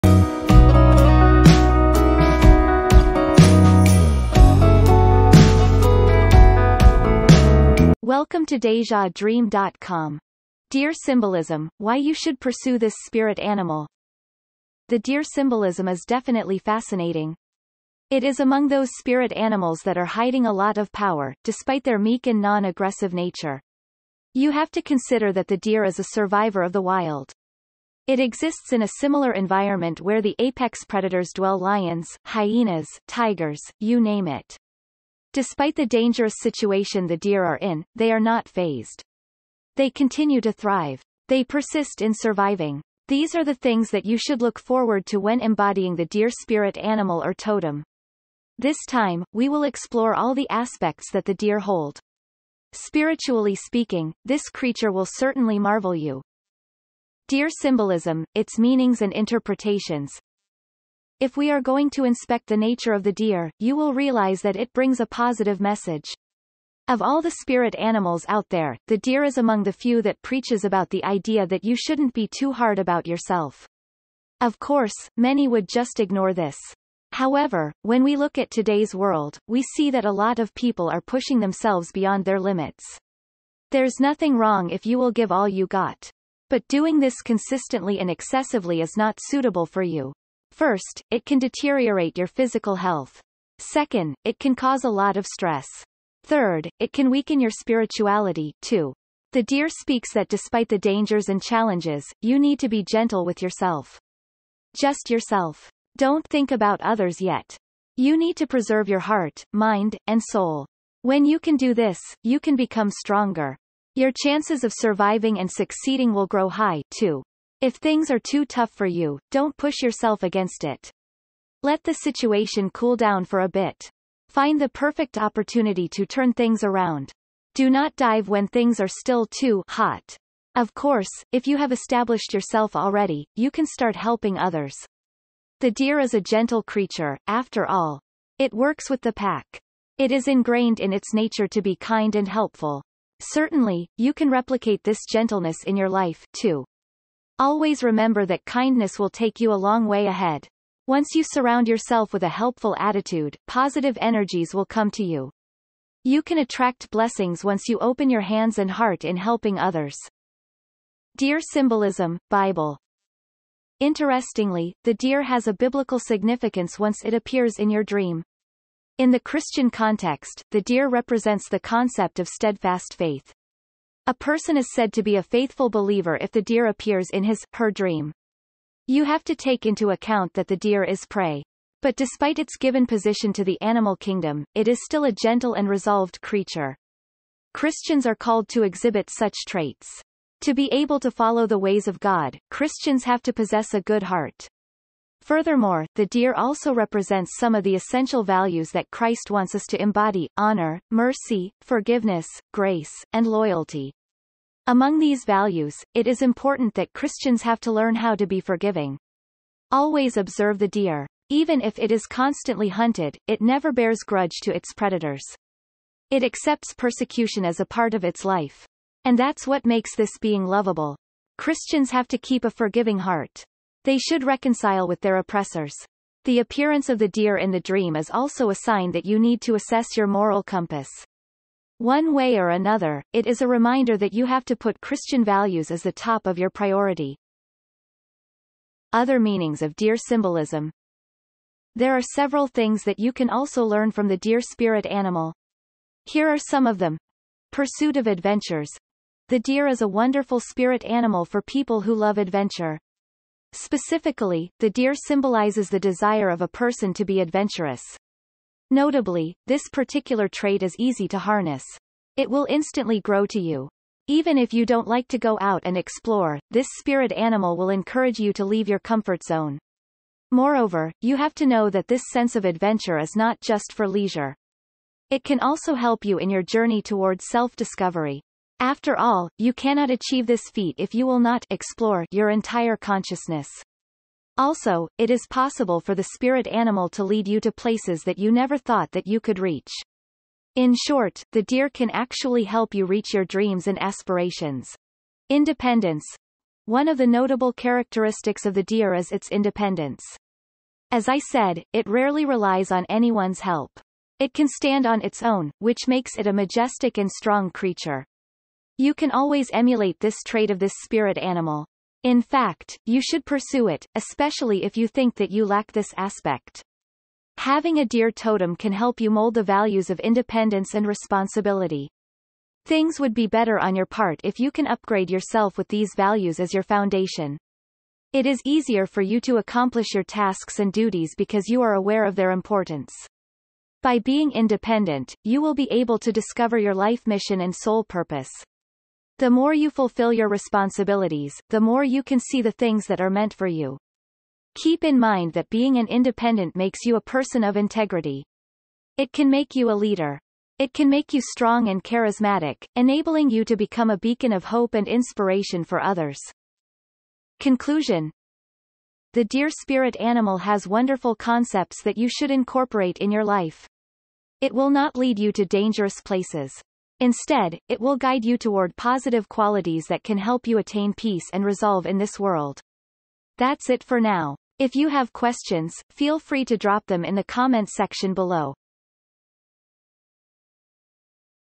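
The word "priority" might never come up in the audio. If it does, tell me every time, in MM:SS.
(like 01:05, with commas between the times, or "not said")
03:56.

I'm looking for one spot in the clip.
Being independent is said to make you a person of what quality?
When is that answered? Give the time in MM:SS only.
05:47.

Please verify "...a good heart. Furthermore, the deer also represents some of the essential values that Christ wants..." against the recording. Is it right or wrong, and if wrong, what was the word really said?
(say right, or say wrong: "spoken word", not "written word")
right.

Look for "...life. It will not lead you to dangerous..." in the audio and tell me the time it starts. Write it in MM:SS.
06:03.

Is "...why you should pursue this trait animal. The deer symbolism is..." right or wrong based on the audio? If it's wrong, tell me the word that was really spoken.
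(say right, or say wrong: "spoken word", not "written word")
wrong: "spirit", not "trait".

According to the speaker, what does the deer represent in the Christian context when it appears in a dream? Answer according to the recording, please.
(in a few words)
Steadfast faith.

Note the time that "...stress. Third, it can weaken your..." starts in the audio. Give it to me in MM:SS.
01:35.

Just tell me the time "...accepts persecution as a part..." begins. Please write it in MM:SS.
03:36.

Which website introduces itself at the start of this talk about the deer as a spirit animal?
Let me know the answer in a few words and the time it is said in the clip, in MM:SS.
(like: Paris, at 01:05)
DejaDream.com, at 00:08.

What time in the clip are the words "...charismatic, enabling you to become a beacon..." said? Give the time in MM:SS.
05:51.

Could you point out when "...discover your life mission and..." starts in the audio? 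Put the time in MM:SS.
05:36.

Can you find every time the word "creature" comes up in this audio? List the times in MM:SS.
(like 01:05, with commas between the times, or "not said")
00:54, 02:16, 03:06, 05:07.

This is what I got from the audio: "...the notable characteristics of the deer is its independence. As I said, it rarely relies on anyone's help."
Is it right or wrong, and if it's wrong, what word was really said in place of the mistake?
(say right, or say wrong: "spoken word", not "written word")
right.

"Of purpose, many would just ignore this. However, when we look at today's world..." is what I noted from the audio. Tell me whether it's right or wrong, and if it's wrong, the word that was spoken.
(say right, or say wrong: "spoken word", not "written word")
wrong: "course", not "purpose".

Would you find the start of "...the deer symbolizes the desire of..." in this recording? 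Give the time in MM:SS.
04:14.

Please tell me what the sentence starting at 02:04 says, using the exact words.
Find the perfect opportunity to turn things around.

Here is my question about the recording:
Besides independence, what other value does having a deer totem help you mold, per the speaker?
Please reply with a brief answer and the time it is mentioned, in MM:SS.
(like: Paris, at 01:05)
Responsibility, at 05:20.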